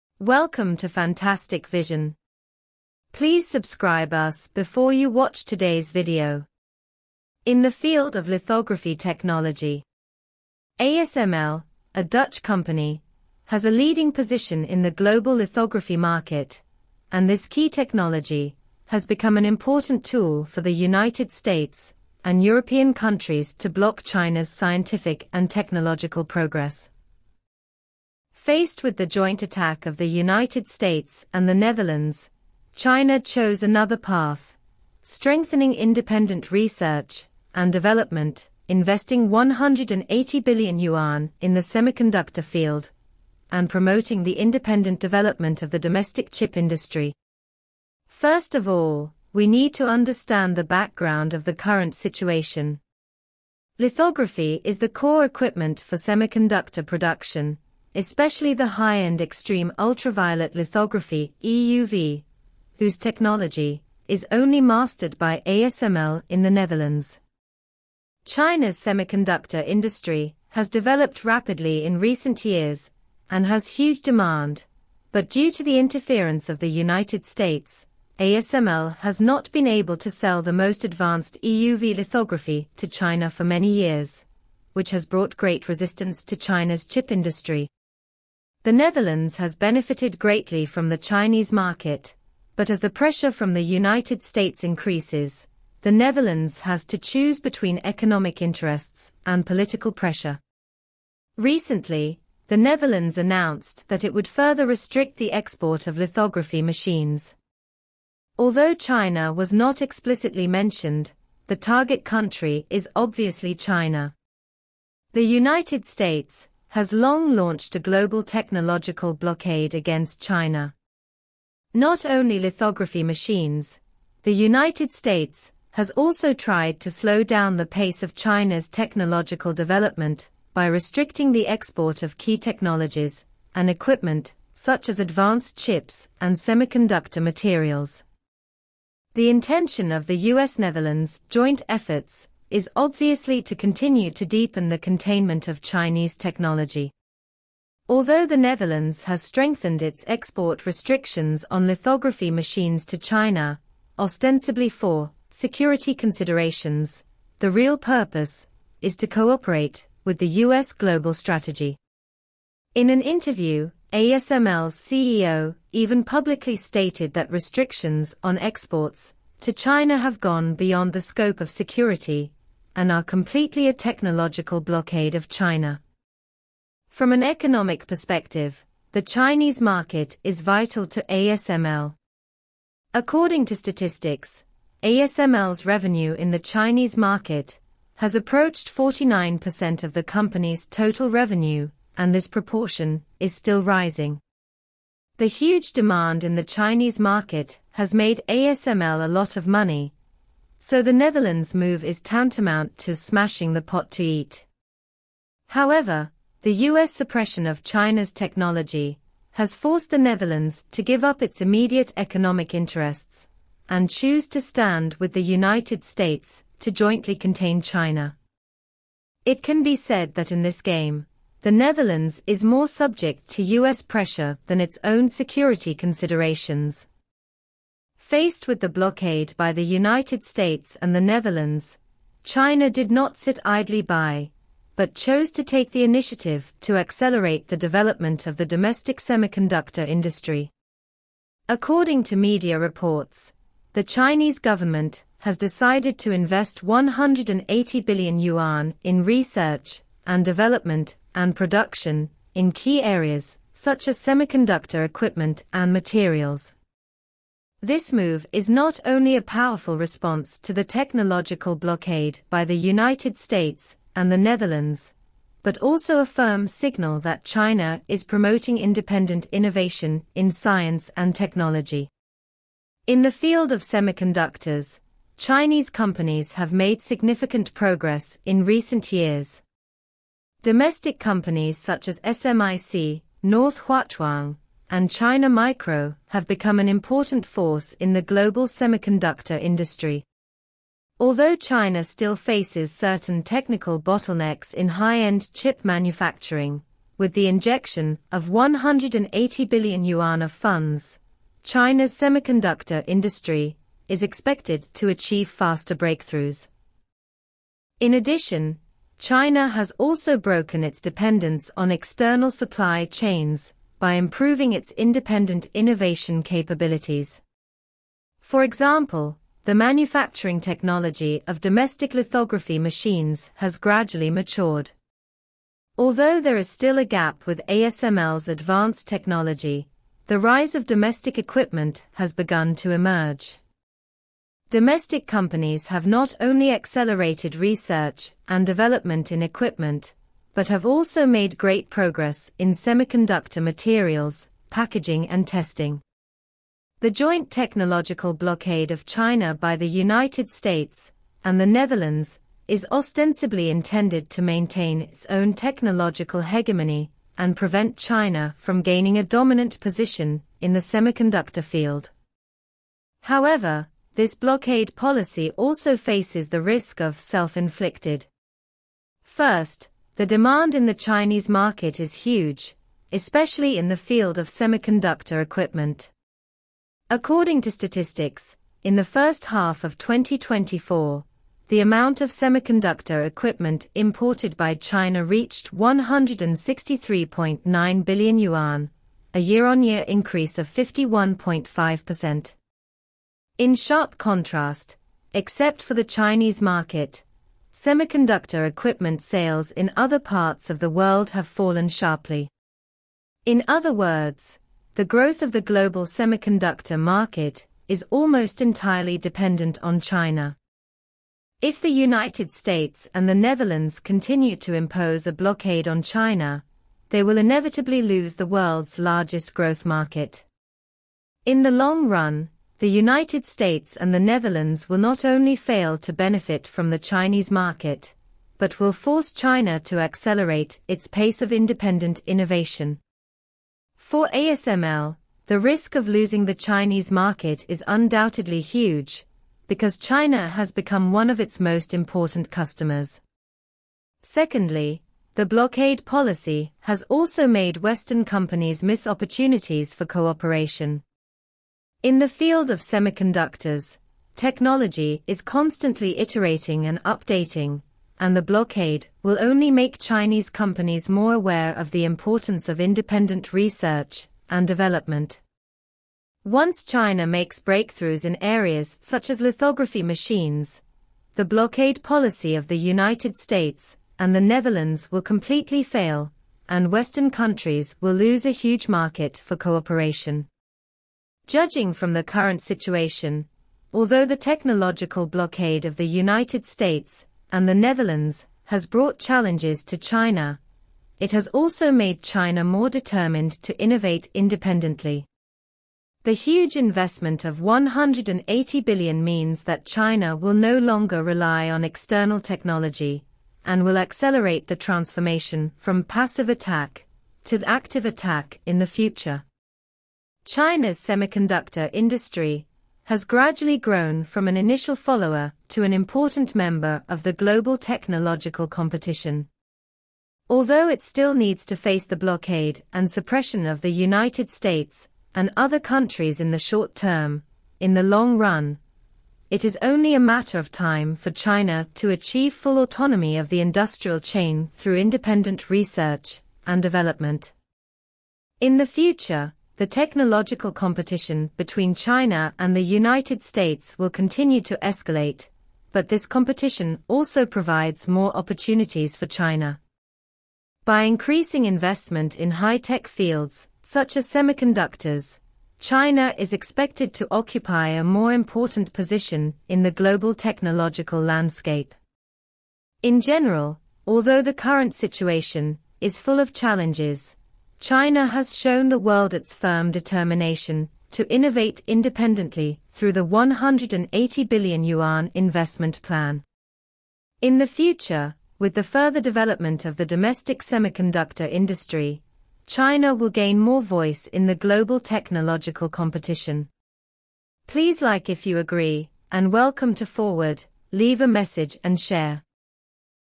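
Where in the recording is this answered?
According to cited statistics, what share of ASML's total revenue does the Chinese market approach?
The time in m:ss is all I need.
3:08.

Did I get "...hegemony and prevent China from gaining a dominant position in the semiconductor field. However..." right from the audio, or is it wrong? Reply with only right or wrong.
right.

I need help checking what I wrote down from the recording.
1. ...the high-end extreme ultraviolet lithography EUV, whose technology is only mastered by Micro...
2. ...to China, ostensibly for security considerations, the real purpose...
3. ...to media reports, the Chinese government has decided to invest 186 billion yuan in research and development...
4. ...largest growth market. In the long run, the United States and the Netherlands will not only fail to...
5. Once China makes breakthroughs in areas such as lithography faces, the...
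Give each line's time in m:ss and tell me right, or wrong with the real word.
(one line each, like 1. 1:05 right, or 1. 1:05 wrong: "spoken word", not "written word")
1. 0:58 wrong: "ASML", not "Micro"
2. 2:32 right
3. 4:02 wrong: "180", not "186"
4. 6:58 right
5. 7:46 wrong: "machines", not "faces".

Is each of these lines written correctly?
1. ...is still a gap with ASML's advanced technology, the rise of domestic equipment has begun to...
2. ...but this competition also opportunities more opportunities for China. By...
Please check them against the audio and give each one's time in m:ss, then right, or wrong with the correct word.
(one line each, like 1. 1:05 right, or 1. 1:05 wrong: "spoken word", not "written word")
1. 5:26 right
2. 9:05 wrong: "provides", not "opportunities".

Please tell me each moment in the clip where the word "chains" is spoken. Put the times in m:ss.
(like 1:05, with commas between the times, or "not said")
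5:12, 8:53.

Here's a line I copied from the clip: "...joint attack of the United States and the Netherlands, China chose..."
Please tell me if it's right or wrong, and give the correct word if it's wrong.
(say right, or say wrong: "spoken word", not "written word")
right.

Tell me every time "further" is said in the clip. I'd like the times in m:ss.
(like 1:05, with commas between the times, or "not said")
1:44, 9:38.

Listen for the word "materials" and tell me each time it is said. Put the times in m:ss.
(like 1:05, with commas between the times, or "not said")
2:17, 4:15, 5:43.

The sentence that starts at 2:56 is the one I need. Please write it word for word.
From an economic perspective, the Chinese market is vital to ASML.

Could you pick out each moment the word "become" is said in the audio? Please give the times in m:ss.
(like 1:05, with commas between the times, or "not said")
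0:19, 4:46, 7:20.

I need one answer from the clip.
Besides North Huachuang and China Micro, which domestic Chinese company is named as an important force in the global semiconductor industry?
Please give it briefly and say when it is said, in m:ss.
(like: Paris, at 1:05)
SMIC, at 4:42.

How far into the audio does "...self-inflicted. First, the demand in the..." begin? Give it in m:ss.
6:06.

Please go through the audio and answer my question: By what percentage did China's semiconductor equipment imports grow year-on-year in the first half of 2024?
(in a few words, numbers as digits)
51.5%.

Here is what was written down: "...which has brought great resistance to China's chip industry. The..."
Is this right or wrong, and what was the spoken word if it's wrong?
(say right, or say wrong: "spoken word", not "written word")
right.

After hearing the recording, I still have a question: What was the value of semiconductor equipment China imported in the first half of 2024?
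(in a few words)
163.9 billion yuan.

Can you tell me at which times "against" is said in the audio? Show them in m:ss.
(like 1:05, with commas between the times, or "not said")
1:59.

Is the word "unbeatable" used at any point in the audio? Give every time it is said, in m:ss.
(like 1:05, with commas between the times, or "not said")
not said.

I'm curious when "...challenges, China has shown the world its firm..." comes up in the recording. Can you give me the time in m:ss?
9:26.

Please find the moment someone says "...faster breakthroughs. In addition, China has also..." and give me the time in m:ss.
5:05.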